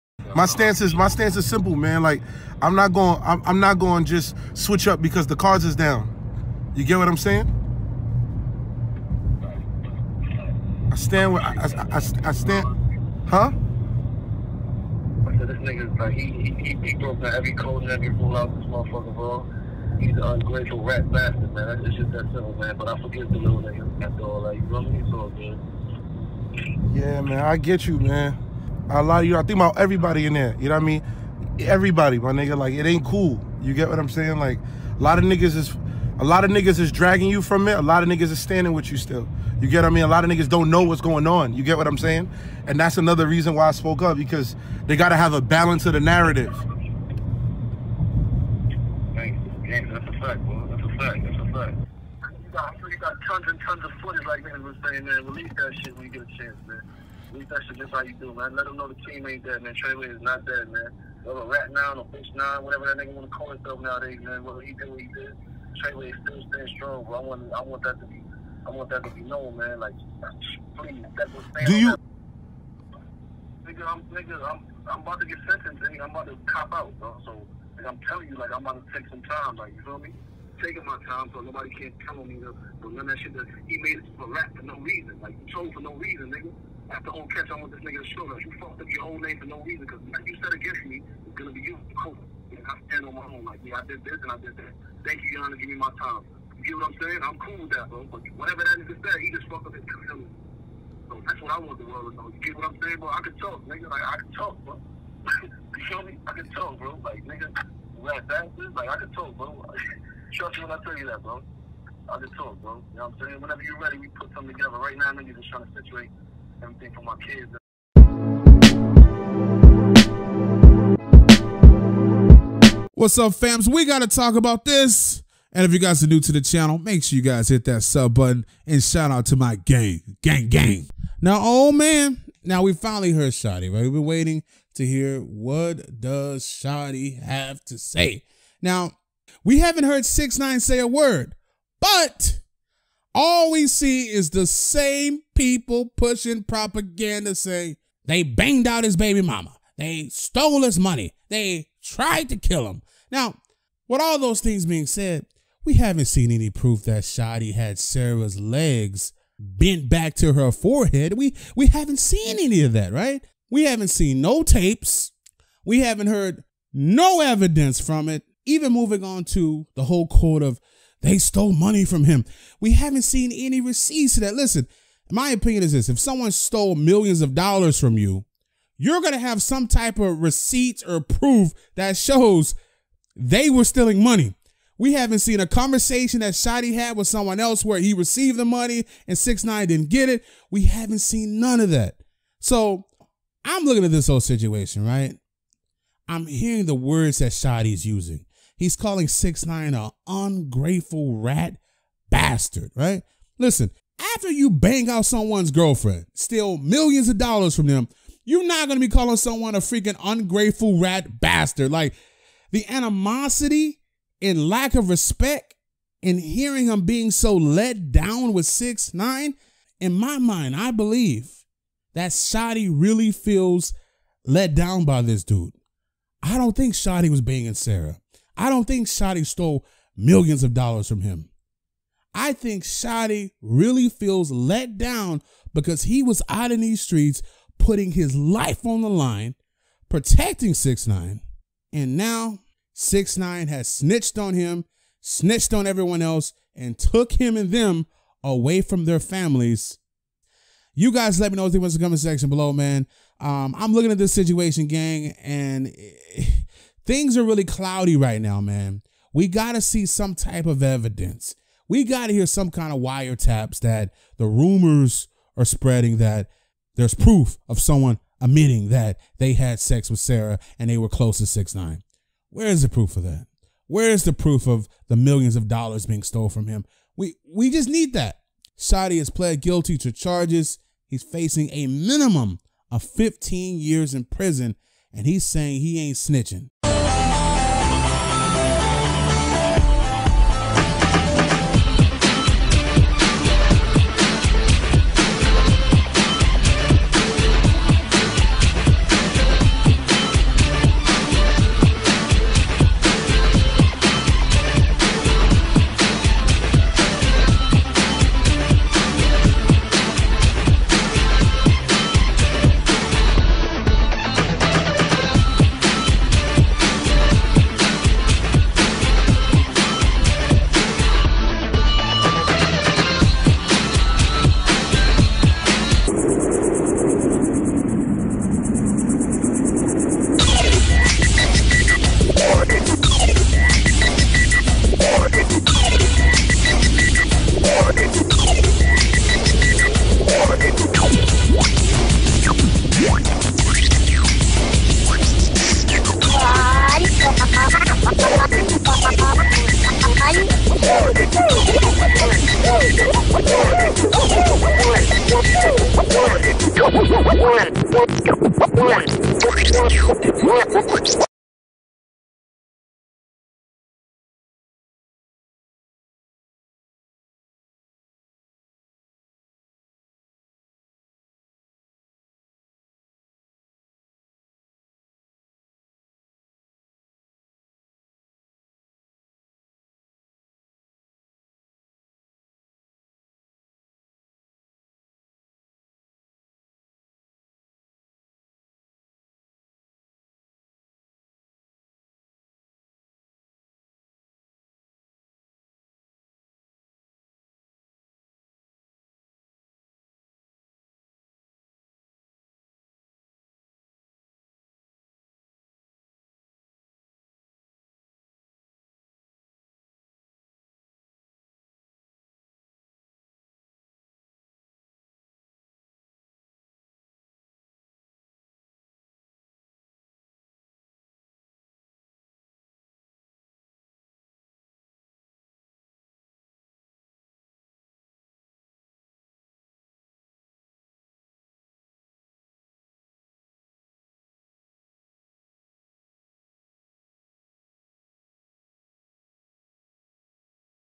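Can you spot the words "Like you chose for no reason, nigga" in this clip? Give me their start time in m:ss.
1:25.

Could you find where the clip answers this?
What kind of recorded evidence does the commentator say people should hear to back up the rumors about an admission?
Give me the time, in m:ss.
4:22.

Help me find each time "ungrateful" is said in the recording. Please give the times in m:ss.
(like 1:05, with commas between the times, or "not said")
0:20, 3:20, 3:30.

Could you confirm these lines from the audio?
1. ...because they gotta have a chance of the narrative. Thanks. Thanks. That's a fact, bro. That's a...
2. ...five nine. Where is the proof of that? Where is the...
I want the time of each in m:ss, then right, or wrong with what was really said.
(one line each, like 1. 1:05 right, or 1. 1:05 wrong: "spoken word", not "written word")
1. 0:44 wrong: "balance", not "chance"
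2. 4:31 wrong: "six", not "five".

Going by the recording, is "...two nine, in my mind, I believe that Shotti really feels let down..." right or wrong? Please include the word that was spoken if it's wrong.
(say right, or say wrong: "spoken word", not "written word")
wrong: "six", not "two".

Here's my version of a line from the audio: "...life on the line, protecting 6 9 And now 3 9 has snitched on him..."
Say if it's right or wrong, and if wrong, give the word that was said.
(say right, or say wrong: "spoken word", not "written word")
wrong: "6", not "3".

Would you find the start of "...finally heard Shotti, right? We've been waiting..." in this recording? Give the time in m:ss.
2:12.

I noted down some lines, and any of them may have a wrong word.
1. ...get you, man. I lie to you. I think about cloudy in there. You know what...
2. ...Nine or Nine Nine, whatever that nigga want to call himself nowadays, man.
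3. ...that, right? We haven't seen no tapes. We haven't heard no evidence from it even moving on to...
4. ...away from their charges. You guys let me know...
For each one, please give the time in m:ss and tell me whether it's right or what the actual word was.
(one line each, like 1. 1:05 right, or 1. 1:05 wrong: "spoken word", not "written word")
1. 0:27 wrong: "everybody", not "cloudy"
2. 1:01 wrong: "Fish", not "Nine"
3. 2:42 right
4. 4:08 wrong: "families", not "charges".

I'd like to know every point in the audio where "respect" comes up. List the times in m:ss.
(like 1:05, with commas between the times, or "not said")
3:34.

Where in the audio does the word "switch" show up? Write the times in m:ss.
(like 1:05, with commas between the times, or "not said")
0:04.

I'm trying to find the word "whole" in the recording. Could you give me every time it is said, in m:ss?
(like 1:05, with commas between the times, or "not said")
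1:29, 2:49, 3:14.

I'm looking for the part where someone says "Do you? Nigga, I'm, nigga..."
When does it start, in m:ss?
1:11.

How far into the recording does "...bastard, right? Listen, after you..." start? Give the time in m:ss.
3:22.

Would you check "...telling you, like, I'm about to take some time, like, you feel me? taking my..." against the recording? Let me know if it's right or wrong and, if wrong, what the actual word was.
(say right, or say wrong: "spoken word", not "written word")
right.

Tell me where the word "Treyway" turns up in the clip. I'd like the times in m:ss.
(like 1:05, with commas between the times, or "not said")
0:59, 1:05.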